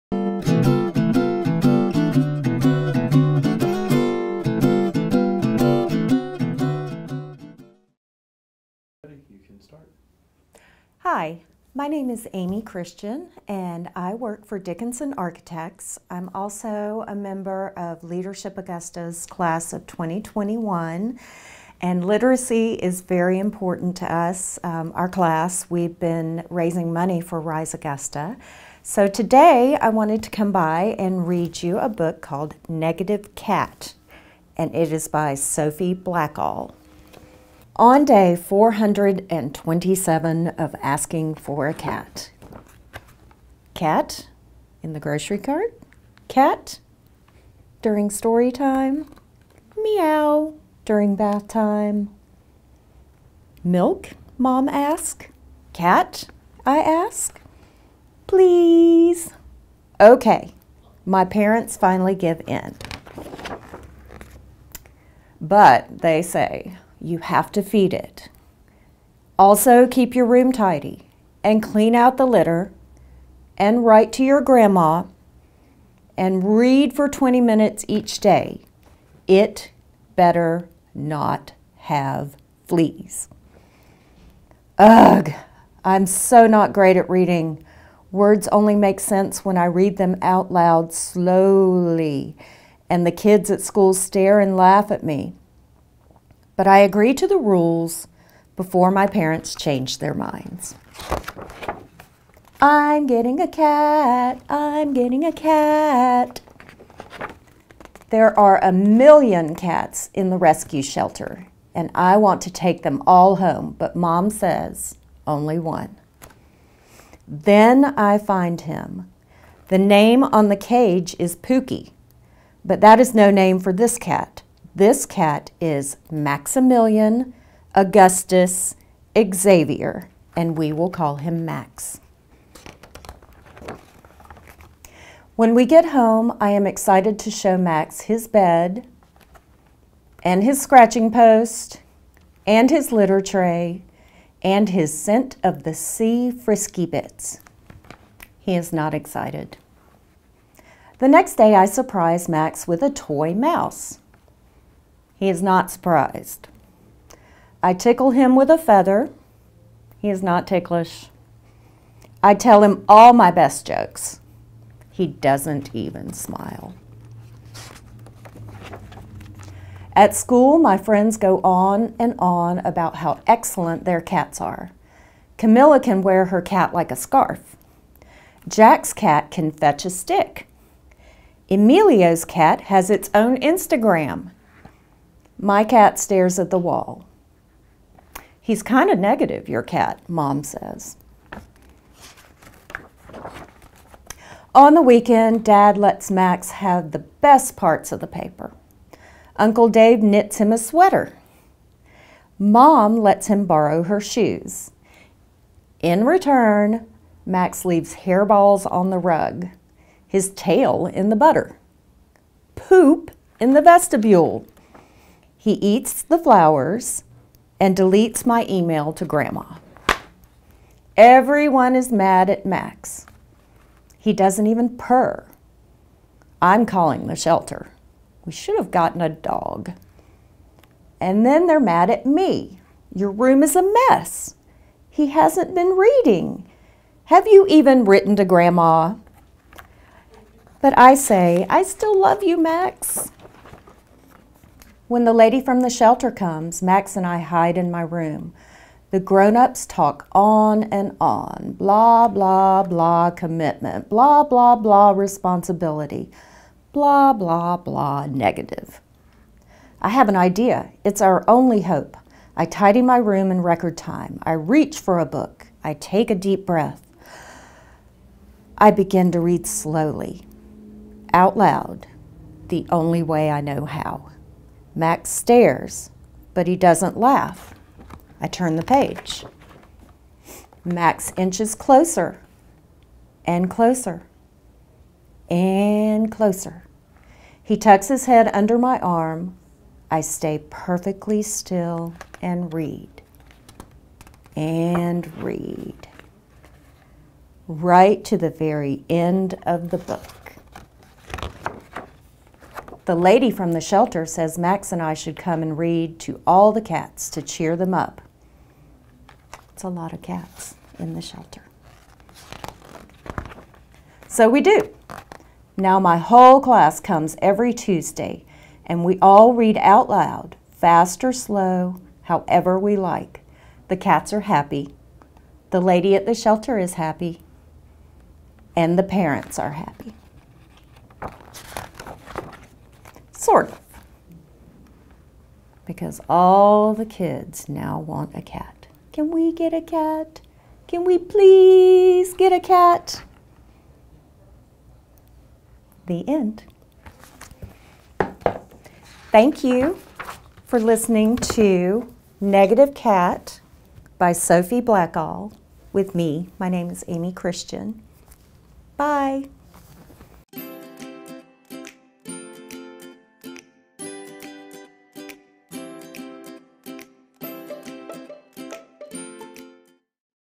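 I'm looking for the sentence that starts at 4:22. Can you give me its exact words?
I tidy my room in record time.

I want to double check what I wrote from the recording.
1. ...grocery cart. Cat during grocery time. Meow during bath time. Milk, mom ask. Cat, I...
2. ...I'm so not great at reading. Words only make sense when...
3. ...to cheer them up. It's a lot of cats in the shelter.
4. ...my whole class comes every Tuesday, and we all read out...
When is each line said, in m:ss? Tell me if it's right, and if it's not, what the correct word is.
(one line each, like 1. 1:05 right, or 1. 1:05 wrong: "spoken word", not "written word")
1. 0:44 wrong: "story", not "grocery"
2. 1:25 right
3. 5:07 right
4. 5:15 right.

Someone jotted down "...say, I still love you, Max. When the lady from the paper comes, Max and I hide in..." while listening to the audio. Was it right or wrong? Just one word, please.
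wrong.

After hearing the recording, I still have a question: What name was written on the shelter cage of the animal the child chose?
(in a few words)
Pookie.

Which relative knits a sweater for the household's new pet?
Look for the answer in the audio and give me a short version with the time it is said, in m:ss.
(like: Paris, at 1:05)
Uncle Dave, at 3:19.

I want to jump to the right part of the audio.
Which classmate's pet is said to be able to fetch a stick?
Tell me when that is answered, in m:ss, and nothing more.
2:58.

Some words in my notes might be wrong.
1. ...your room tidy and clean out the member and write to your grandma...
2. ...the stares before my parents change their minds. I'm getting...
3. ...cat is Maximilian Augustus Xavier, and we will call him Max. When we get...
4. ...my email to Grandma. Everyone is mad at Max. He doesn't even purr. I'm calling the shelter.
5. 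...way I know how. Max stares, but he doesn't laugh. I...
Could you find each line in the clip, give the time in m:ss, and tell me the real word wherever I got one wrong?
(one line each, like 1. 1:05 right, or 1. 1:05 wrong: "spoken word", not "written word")
1. 1:10 wrong: "litter", not "member"
2. 1:37 wrong: "rules", not "stares"
3. 2:05 right
4. 3:38 right
5. 4:33 right.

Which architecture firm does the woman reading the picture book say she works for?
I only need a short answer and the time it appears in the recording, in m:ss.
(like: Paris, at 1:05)
Dickinson Architects, at 0:14.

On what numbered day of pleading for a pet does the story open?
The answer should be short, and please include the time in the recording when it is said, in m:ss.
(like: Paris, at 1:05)
427, at 0:38.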